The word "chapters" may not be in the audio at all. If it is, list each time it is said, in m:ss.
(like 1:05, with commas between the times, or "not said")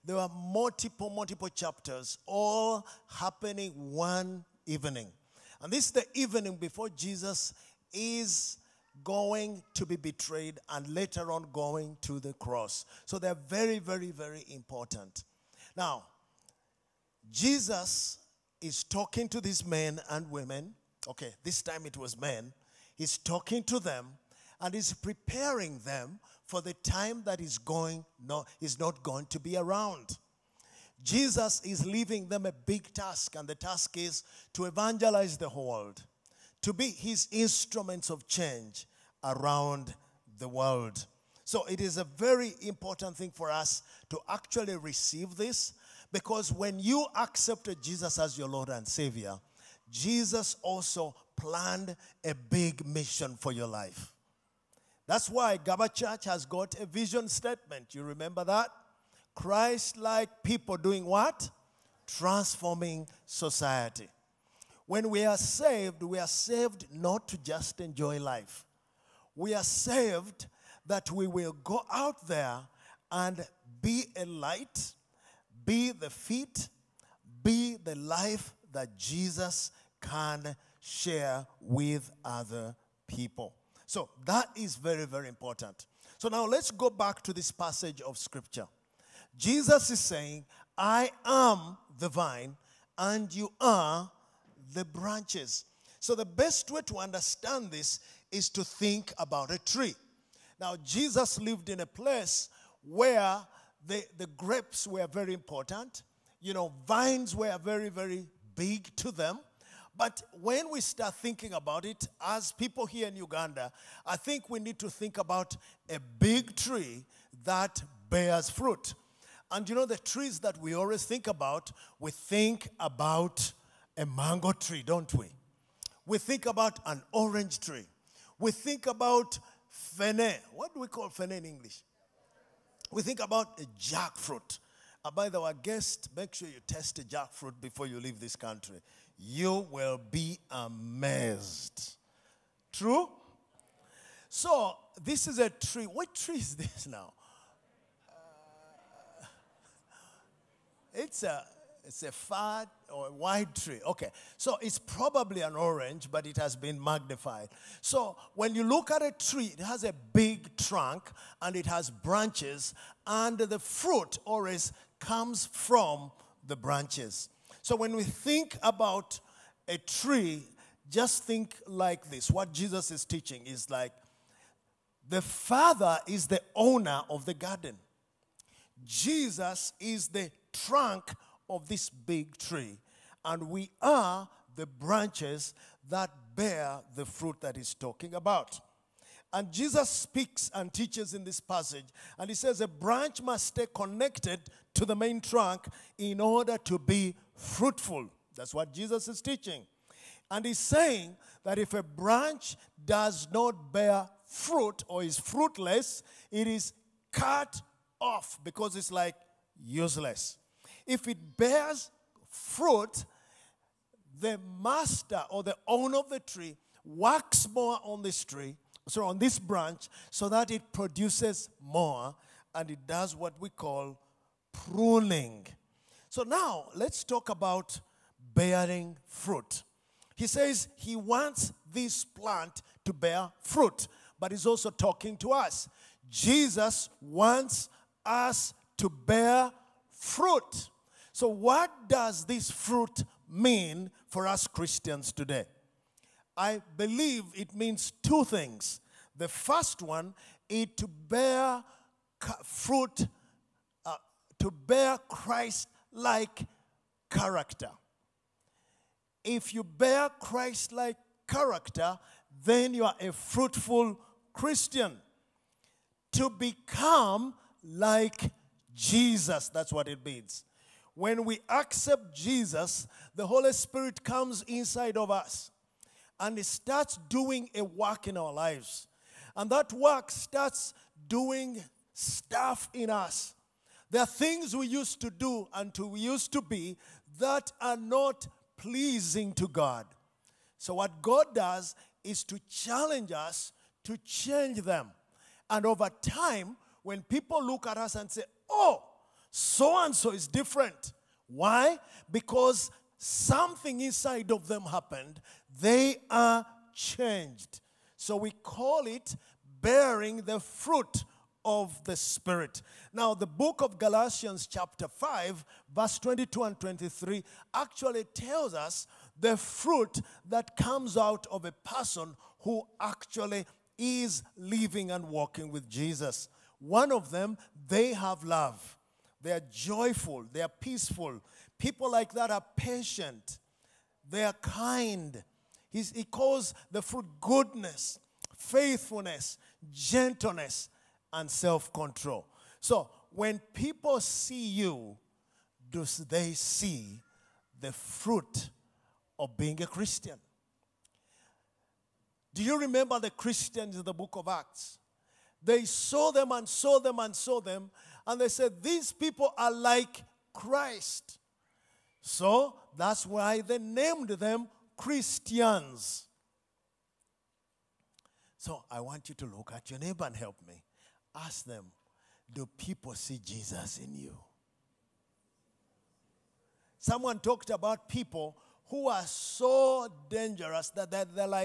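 0:01, 5:14.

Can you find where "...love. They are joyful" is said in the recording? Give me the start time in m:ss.
5:28.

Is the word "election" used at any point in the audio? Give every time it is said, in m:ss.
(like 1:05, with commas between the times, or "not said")
not said.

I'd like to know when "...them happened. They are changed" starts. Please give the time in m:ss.
5:04.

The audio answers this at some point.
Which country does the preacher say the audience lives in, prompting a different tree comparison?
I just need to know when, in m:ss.
1:53.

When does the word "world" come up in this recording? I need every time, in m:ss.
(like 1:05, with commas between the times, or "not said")
0:35, 0:40.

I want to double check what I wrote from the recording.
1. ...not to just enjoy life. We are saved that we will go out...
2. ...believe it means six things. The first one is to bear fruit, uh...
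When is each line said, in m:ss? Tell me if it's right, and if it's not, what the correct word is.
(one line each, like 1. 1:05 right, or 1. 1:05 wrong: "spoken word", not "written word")
1. 1:06 right
2. 4:06 wrong: "two", not "six".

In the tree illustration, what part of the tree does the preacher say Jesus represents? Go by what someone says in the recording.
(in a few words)
The trunk.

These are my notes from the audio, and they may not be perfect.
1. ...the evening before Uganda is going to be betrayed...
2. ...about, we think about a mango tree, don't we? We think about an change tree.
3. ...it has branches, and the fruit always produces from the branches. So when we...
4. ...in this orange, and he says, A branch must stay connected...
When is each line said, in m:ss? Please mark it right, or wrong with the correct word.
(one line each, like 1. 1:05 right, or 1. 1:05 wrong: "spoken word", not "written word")
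1. 0:05 wrong: "Jesus", not "Uganda"
2. 2:01 wrong: "orange", not "change"
3. 2:41 wrong: "comes", not "produces"
4. 3:11 wrong: "passage", not "orange".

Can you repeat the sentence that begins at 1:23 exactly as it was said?
So that is very, very important.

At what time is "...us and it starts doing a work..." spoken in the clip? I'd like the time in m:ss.
4:35.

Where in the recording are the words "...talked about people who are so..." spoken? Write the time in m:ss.
6:17.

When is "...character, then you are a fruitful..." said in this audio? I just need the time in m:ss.
4:21.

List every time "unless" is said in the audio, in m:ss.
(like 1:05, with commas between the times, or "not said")
not said.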